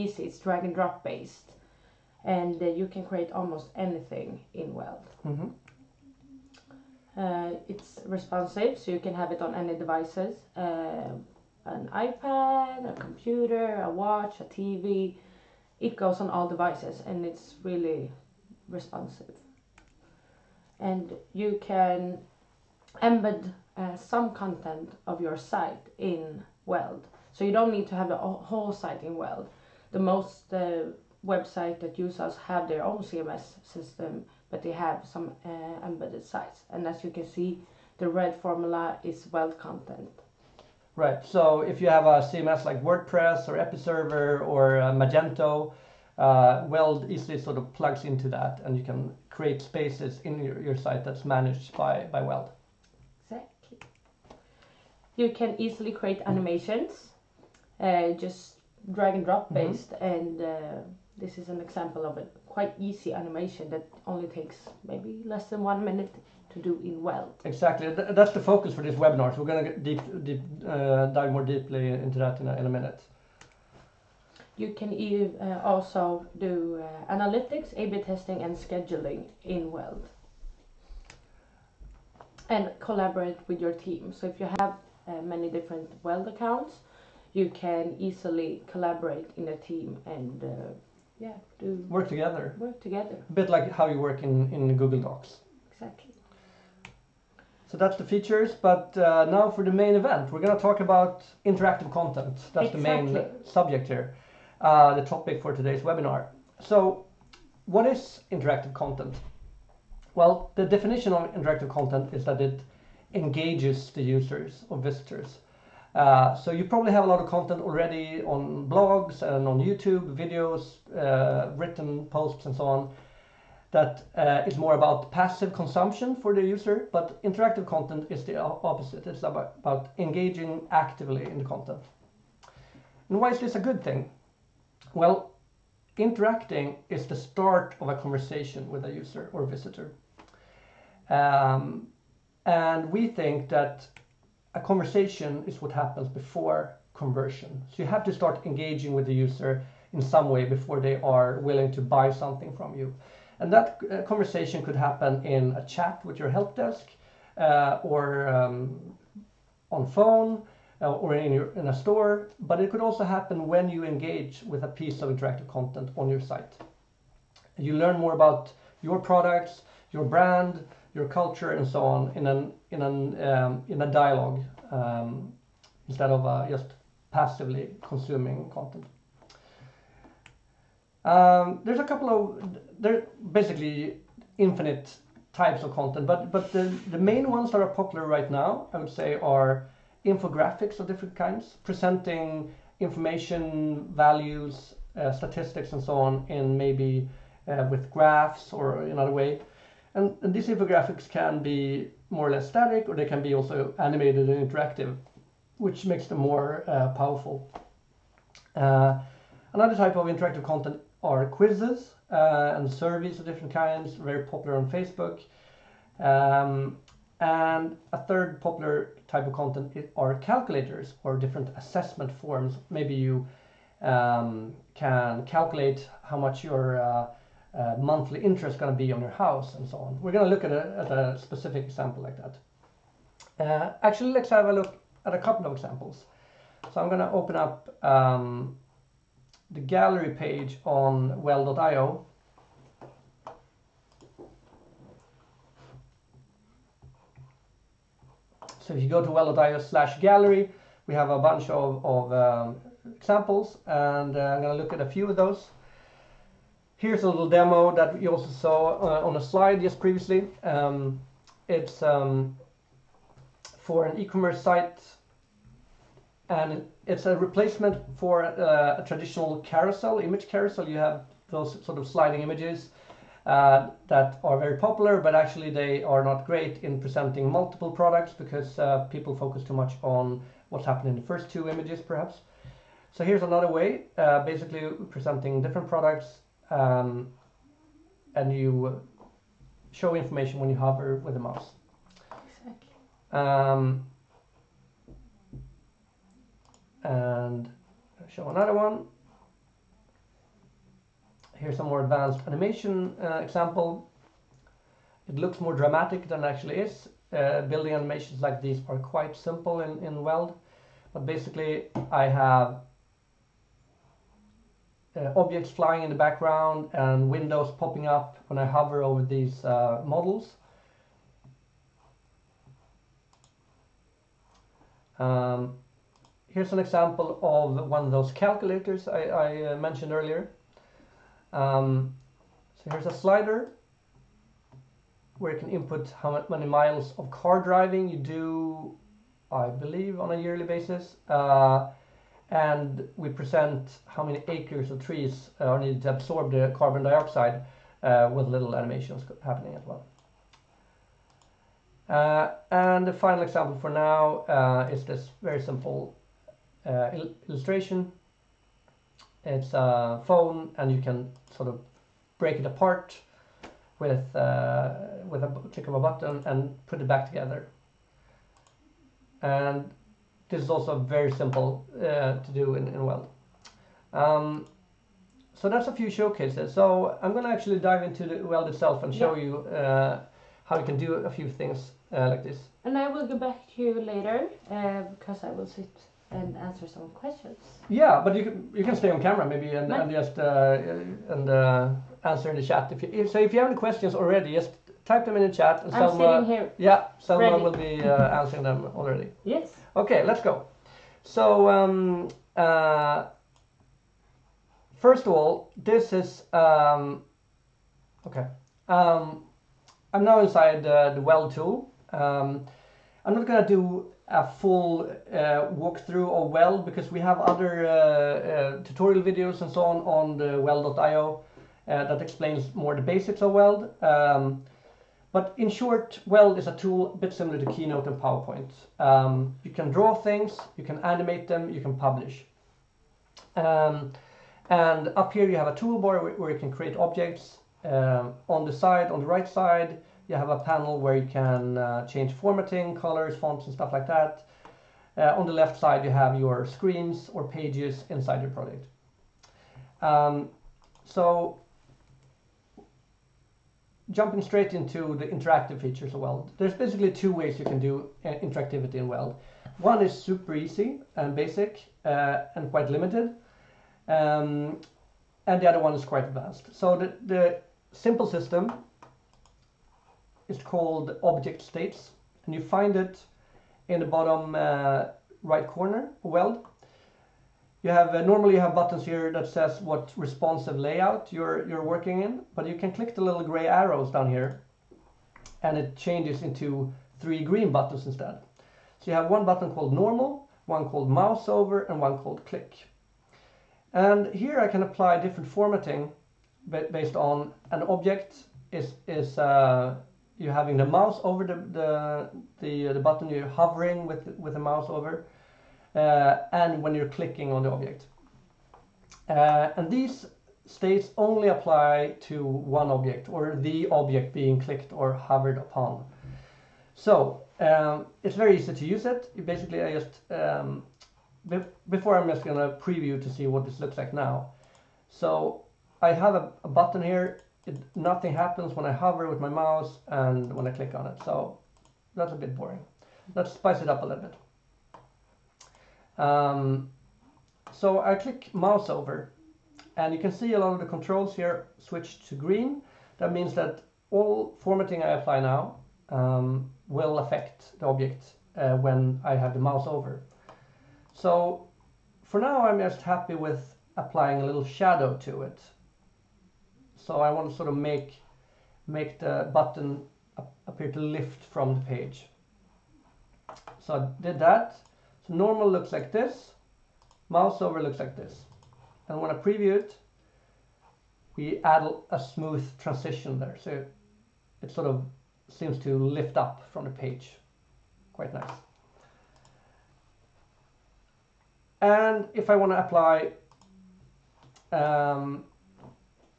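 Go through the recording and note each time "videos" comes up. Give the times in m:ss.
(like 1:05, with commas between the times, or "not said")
2:00, 6:59.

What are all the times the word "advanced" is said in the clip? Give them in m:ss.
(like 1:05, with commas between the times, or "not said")
5:01, 7:46.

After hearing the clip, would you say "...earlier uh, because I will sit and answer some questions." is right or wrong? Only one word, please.
wrong.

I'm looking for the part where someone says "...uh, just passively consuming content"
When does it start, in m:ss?
2:56.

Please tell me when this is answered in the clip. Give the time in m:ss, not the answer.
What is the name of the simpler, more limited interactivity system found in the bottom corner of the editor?
7:51.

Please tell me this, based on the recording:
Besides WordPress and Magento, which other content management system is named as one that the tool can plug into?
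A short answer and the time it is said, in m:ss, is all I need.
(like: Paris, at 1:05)
Episerver, at 0:43.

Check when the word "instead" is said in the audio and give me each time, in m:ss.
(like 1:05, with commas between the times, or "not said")
2:55, 8:07.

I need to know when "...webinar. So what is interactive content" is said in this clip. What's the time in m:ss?
1:45.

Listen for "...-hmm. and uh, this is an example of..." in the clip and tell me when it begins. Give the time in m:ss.
0:59.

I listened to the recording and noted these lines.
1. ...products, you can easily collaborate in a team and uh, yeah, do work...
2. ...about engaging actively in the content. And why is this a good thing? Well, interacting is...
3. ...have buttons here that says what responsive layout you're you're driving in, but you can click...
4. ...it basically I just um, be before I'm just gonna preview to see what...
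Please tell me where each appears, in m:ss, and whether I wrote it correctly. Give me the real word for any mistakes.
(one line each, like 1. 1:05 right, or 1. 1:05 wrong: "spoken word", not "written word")
1. 1:26 wrong: "accounts", not "products"
2. 2:09 right
3. 7:58 wrong: "working", not "driving"
4. 8:38 right.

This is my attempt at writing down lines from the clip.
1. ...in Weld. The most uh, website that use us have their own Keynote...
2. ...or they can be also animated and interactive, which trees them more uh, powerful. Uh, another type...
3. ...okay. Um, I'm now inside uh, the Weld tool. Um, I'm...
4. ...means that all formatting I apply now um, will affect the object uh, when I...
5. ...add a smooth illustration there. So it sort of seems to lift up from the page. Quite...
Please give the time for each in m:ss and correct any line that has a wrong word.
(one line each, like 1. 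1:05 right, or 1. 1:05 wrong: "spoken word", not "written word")
1. 0:29 wrong: "CMS", not "Keynote"
2. 3:22 wrong: "makes", not "trees"
3. 6:48 right
4. 9:03 right
5. 9:31 wrong: "transition", not "illustration".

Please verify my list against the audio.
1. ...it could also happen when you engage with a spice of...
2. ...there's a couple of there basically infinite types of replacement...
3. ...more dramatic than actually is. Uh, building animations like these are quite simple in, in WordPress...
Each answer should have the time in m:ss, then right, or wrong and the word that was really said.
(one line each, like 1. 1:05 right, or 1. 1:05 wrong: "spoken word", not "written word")
1. 2:42 wrong: "piece", not "spice"
2. 3:01 wrong: "content", not "replacement"
3. 5:05 wrong: "Weld", not "WordPress".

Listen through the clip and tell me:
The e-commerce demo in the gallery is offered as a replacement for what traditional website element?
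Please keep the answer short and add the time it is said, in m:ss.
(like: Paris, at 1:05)
Image carousel, at 4:30.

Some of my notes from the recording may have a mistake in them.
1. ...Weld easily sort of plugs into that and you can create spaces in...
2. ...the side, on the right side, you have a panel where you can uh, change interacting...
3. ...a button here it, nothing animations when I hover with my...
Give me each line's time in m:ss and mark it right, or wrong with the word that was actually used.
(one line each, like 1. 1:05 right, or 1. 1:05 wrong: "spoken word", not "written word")
1. 0:46 right
2. 7:18 wrong: "formatting", not "interacting"
3. 8:46 wrong: "happens", not "animations".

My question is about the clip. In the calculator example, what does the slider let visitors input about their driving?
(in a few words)
Miles of car driving.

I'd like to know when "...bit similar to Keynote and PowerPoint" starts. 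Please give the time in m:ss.
7:06.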